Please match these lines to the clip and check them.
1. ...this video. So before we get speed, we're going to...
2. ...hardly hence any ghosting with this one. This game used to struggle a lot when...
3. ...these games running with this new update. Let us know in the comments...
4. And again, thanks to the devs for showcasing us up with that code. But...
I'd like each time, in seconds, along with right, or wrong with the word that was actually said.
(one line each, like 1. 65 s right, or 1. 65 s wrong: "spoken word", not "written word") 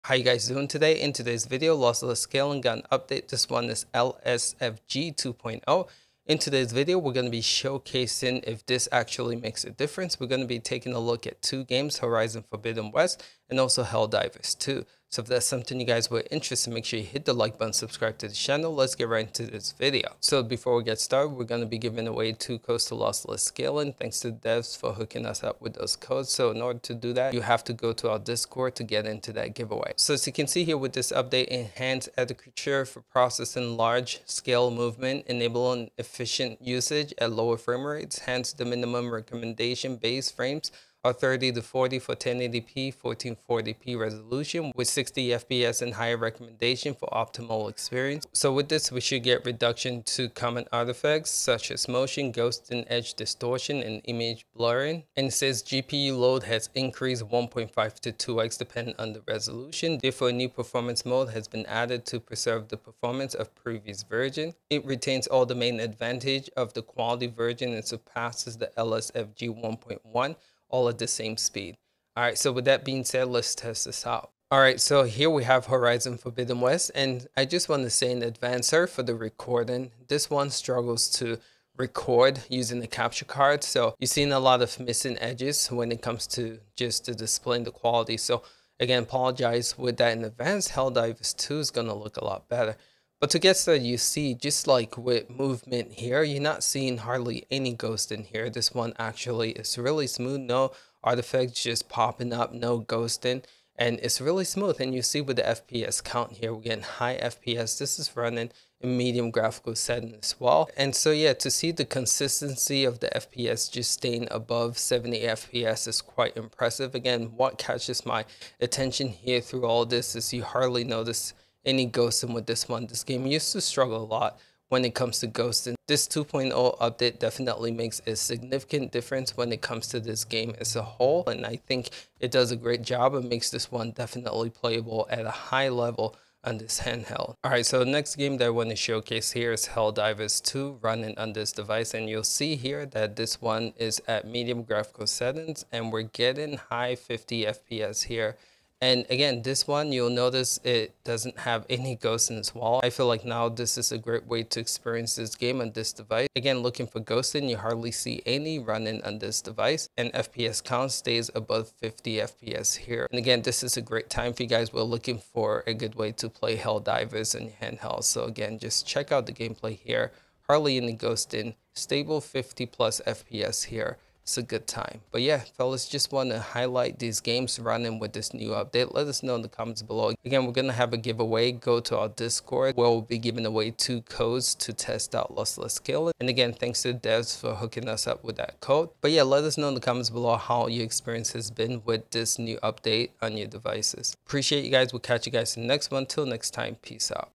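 1. 19 s wrong: "started", not "speed"
2. 120 s wrong: "notice", not "hence"
3. 176 s right
4. 186 s wrong: "hooking", not "showcasing".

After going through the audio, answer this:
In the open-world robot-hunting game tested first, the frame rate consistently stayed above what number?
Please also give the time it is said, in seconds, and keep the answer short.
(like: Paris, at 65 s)
70, at 114 s.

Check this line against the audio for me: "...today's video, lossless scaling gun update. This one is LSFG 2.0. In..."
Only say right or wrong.
right.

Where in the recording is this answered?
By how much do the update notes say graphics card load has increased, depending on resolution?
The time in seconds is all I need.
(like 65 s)
57 s.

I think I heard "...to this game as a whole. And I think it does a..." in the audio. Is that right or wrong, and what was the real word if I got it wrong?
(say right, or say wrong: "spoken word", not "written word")
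right.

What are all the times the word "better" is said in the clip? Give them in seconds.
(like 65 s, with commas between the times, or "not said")
92 s.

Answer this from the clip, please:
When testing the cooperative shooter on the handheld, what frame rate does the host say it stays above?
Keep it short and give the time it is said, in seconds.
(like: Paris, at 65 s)
50, at 161 s.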